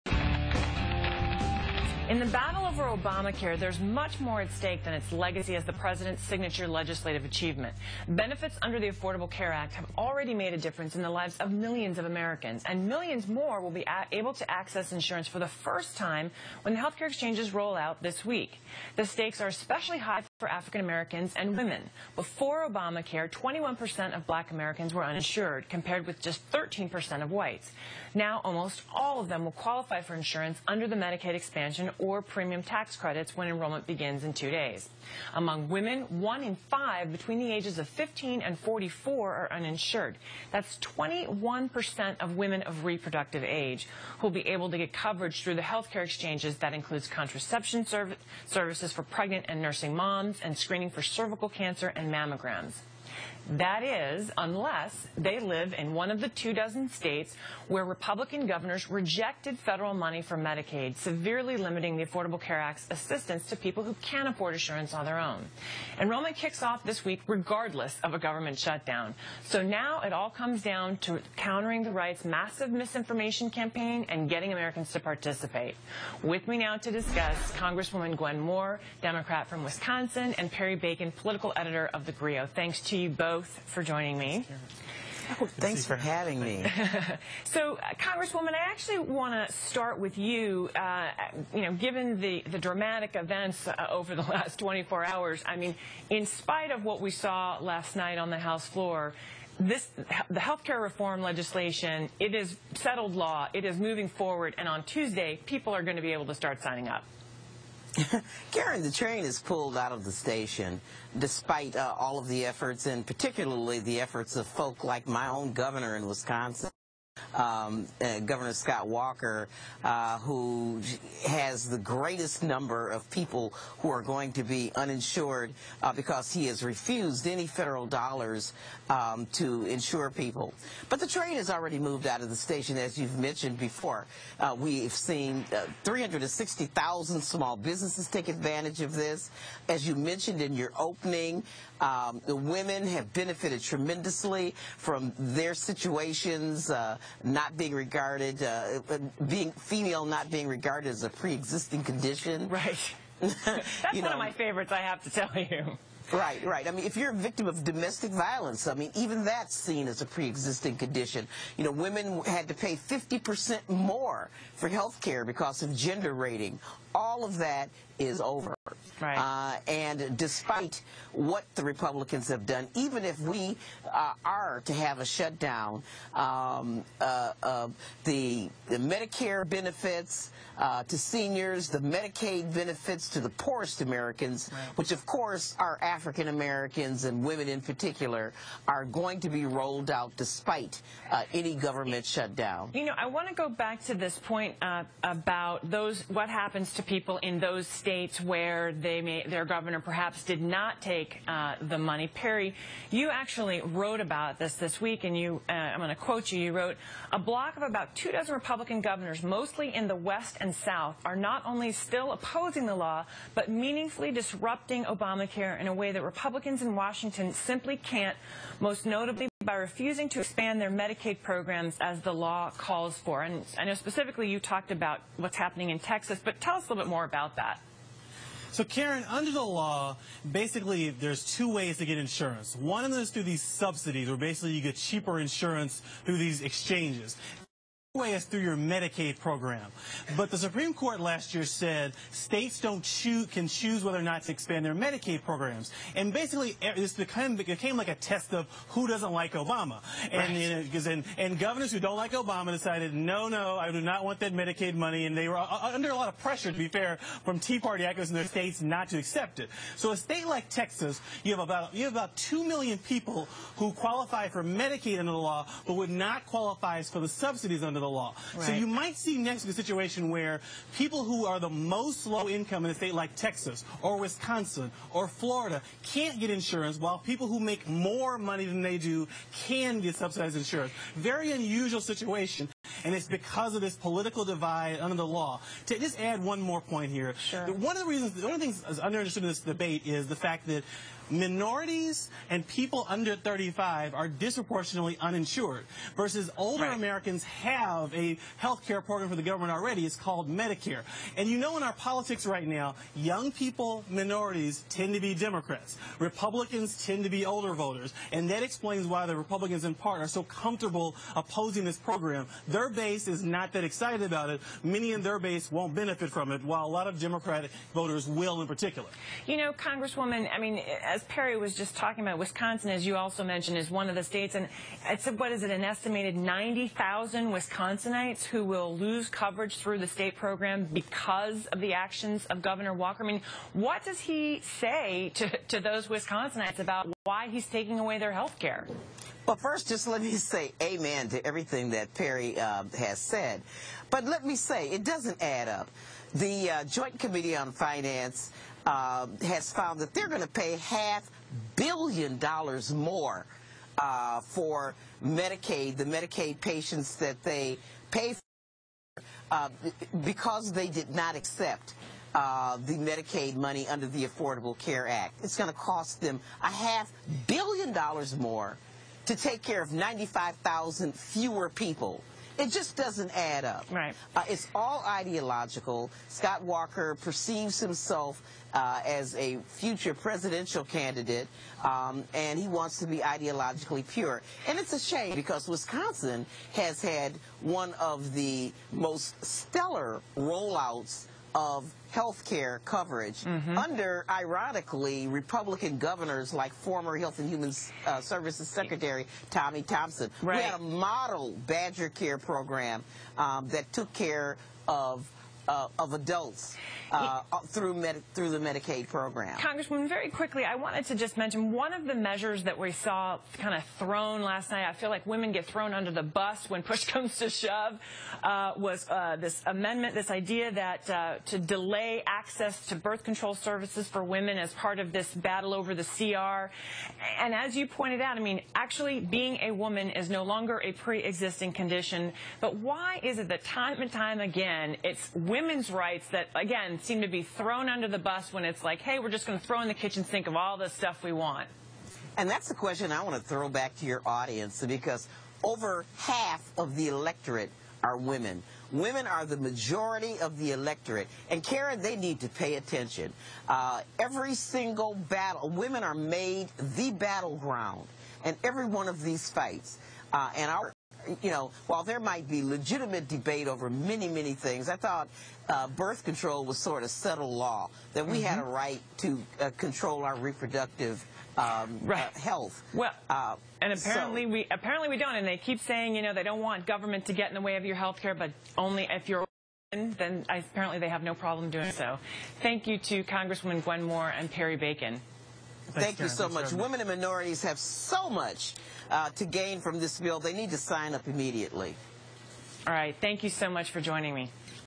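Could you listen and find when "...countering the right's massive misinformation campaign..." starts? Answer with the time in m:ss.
1:11.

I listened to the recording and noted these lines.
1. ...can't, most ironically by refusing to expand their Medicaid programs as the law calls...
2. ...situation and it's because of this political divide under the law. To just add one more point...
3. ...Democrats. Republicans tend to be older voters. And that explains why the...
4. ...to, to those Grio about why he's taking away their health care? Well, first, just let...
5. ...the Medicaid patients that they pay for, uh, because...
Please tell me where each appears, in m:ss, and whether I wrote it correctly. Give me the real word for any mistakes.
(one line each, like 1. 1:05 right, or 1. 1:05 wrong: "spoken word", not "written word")
1. 3:37 wrong: "notably", not "ironically"
2. 4:41 right
3. 5:05 right
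4. 5:35 wrong: "Wisconsinites", not "Grio"
5. 5:55 right.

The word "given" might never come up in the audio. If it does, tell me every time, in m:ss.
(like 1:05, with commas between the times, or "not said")
1:31.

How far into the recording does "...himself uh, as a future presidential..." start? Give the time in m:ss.
6:17.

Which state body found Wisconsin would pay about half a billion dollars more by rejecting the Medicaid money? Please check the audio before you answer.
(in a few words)
Joint Committee on Finance.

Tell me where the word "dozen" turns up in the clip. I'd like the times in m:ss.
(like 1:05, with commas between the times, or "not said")
0:56, 3:28.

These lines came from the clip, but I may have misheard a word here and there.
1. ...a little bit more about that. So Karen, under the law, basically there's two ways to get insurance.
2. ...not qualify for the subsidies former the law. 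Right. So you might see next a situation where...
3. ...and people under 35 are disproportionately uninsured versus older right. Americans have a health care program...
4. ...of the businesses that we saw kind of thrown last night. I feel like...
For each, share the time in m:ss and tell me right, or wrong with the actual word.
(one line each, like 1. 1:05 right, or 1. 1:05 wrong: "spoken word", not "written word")
1. 3:46 right
2. 4:25 wrong: "under", not "former"
3. 4:52 right
4. 6:51 wrong: "measures", not "businesses".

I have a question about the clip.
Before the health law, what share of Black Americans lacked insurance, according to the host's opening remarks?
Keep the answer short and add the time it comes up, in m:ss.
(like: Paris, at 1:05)
21%, at 0:23.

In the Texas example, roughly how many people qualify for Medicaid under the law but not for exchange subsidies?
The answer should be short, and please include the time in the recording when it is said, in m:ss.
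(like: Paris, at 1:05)
2 million, at 4:22.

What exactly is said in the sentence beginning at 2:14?
Uh, we've seen uh, 360,000 small businesses take advantage of this.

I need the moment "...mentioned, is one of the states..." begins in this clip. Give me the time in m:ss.
5:23.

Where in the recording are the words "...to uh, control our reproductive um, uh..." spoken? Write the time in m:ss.
7:48.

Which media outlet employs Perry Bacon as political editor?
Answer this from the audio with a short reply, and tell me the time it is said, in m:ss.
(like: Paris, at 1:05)
The Grio, at 1:22.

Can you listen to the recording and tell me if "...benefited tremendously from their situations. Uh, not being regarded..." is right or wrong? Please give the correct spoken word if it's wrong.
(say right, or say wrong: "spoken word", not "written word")
right.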